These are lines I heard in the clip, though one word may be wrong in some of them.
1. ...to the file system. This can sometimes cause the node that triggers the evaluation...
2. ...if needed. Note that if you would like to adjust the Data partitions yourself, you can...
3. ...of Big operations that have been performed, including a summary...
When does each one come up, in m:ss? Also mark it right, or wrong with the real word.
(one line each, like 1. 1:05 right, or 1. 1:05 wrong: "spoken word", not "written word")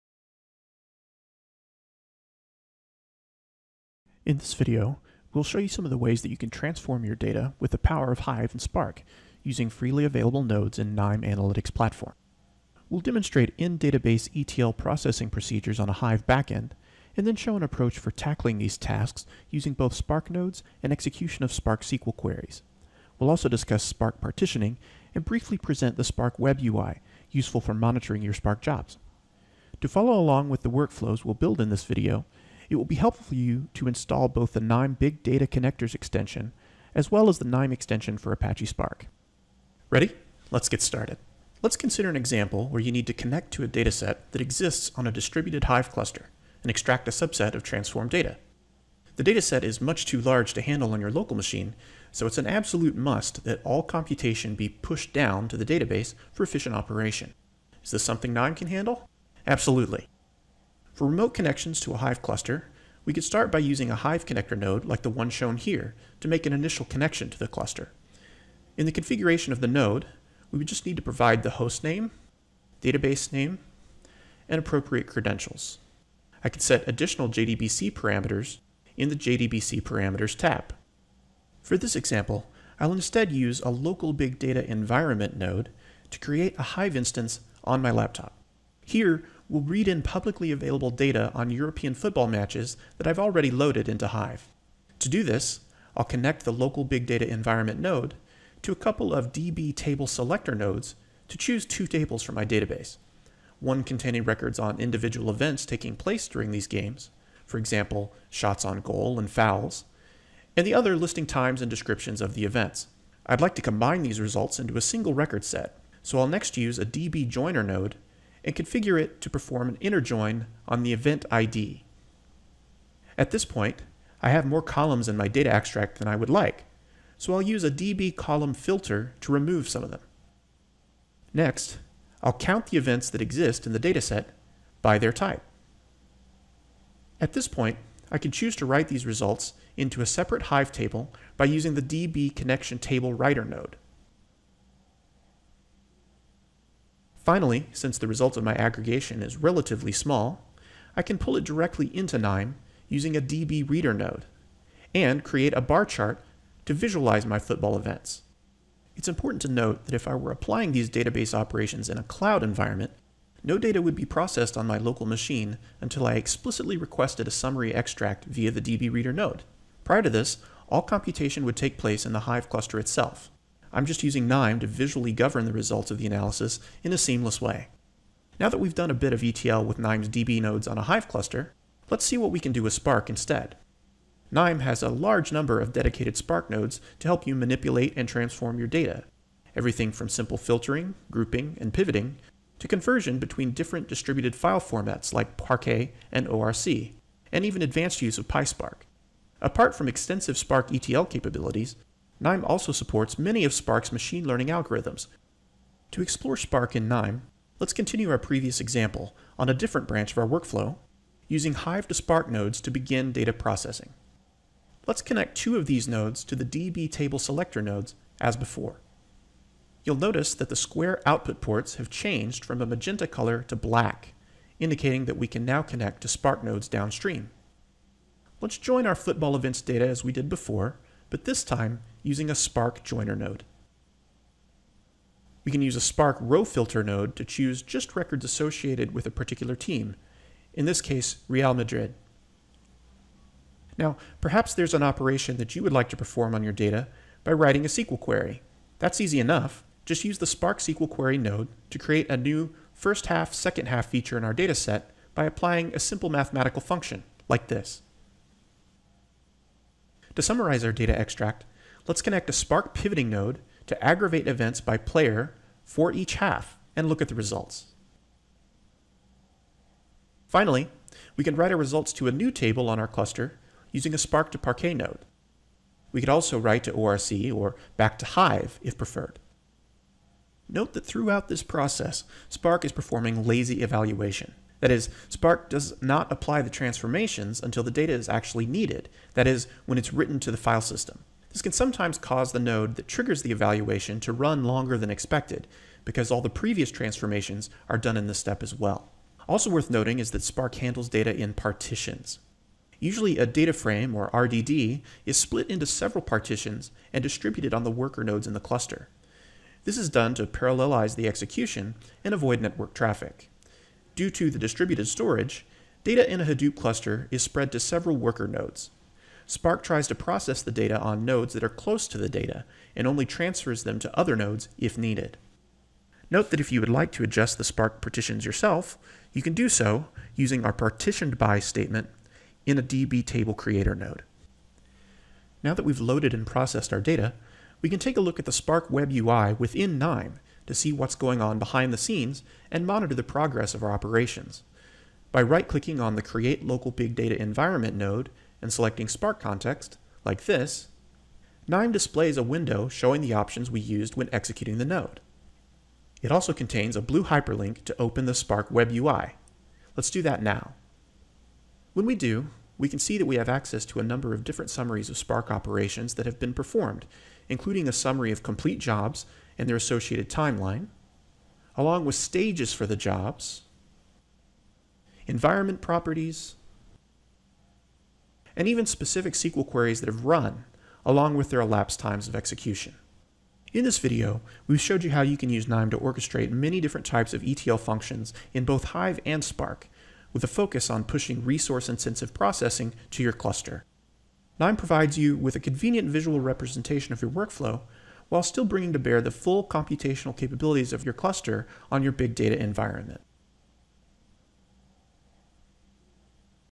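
1. 4:50 right
2. 5:24 wrong: "Spark", not "Data"
3. 6:04 wrong: "Spark", not "Big".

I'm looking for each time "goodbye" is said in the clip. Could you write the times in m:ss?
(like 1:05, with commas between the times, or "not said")
not said.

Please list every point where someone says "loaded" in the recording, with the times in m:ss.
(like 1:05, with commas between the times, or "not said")
1:33, 5:35.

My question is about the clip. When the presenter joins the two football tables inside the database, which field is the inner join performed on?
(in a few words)
event ID.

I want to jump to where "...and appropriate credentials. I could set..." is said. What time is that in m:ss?
1:14.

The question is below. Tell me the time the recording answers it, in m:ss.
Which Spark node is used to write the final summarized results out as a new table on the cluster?
4:33.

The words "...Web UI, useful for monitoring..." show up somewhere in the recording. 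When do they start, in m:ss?
0:26.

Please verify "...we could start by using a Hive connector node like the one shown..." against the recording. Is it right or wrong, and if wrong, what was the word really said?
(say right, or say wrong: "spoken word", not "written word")
right.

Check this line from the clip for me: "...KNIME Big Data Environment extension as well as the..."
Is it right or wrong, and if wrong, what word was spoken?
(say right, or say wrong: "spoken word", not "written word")
wrong: "Connectors", not "Environment".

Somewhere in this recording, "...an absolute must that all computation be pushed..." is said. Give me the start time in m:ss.
0:52.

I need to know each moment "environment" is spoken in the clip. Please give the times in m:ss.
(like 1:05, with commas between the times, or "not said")
1:24, 1:37, 2:42, 5:47, 6:15, 6:42.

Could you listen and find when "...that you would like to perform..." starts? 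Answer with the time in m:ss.
4:05.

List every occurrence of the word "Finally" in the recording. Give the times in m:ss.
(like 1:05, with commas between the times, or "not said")
2:27, 4:30.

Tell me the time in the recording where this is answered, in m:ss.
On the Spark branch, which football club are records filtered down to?
4:01.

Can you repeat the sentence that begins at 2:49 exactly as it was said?
Prior to this, all computation would take place in the Hive cluster itself.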